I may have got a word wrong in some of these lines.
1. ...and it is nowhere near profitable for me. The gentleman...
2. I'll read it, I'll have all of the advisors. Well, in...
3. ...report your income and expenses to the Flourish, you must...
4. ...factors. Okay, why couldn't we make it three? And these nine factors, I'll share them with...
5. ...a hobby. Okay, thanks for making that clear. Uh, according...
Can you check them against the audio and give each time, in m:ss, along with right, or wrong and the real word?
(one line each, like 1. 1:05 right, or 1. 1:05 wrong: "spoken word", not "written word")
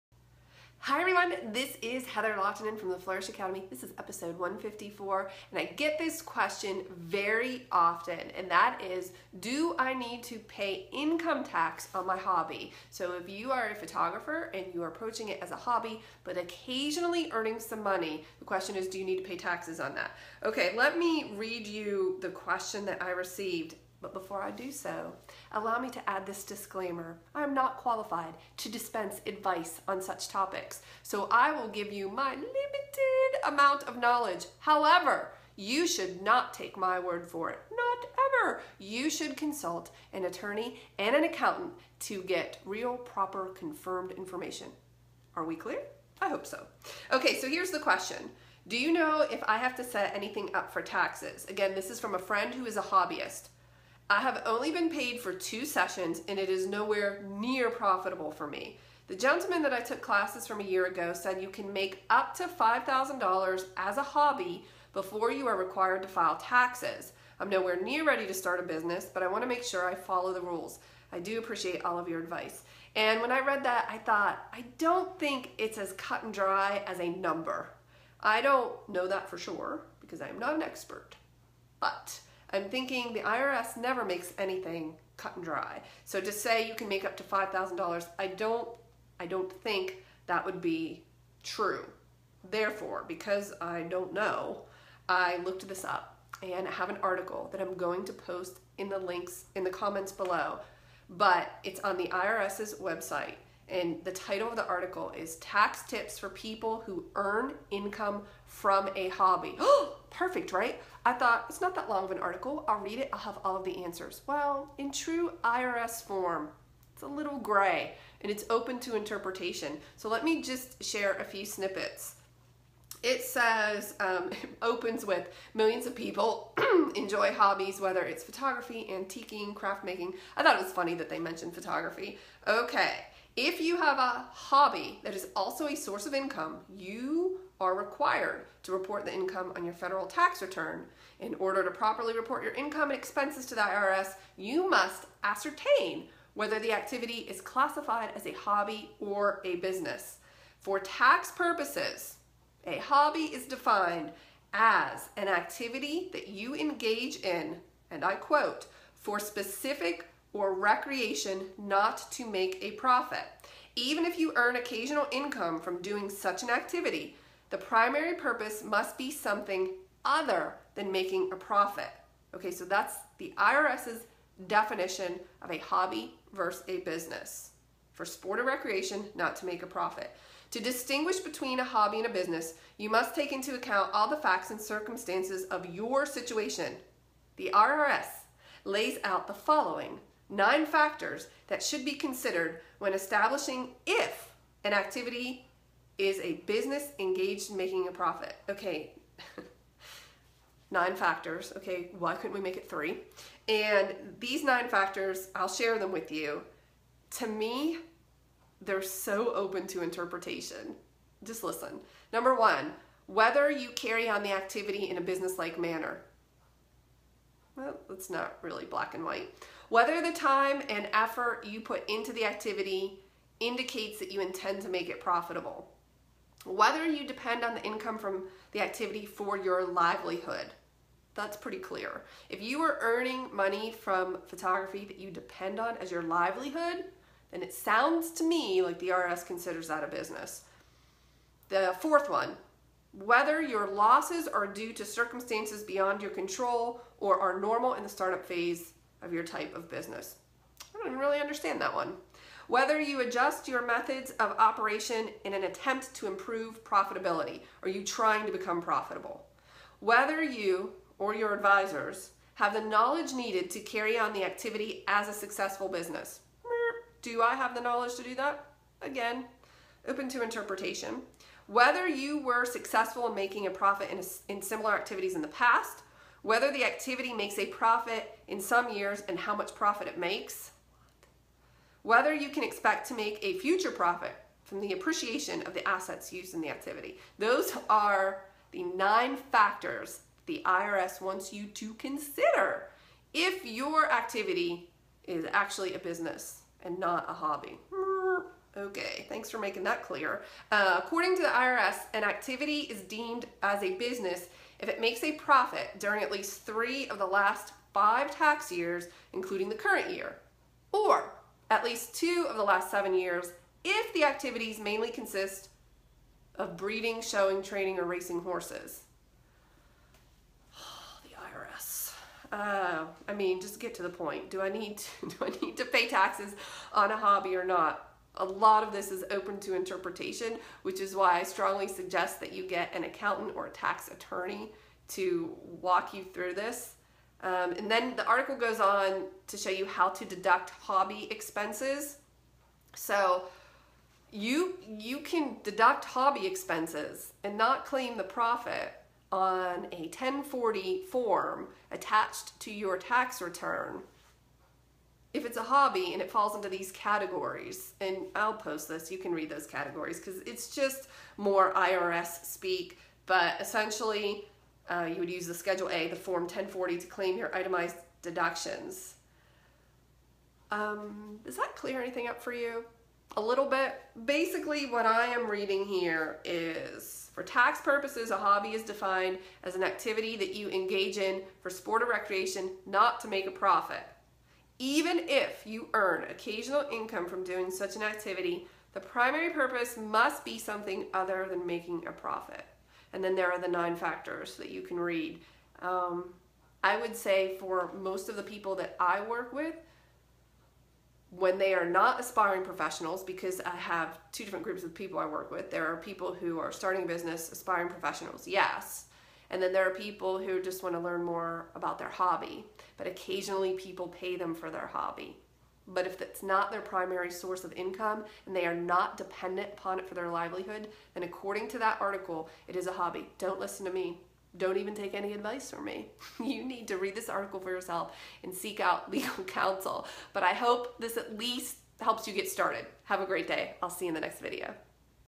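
1. 0:56 right
2. 1:52 wrong: "answers", not "advisors"
3. 2:22 wrong: "IRS", not "Flourish"
4. 3:20 right
5. 4:57 right.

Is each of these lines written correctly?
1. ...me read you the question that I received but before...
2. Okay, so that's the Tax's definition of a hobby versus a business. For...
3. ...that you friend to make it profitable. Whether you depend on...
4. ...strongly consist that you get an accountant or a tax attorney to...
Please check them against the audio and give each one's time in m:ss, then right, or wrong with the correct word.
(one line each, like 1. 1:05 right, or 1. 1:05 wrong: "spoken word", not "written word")
1. 0:20 right
2. 2:52 wrong: "IRS", not "Tax"
3. 3:43 wrong: "intend", not "friend"
4. 5:31 wrong: "suggest", not "consist".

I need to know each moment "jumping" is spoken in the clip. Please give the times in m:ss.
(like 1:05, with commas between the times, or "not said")
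not said.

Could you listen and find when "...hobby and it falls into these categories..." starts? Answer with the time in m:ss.
5:55.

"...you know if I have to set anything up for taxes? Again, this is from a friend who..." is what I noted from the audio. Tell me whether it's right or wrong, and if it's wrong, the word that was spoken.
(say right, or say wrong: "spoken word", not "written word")
right.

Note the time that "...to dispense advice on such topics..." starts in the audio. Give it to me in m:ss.
0:28.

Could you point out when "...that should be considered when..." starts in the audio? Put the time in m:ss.
3:11.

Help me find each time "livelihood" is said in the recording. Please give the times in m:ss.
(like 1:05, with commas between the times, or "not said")
3:49, 3:56, 7:00.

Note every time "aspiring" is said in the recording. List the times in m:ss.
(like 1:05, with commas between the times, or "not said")
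6:41, 6:47.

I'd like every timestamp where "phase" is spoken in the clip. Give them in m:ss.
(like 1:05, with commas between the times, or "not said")
4:08.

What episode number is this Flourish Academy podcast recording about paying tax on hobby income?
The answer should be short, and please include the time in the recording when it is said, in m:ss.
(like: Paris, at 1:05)
154, at 0:04.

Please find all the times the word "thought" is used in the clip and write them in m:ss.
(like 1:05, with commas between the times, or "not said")
1:13, 1:51, 2:10.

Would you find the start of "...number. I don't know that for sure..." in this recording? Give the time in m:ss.
1:17.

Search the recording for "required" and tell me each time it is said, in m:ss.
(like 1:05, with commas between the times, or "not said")
1:05, 2:17.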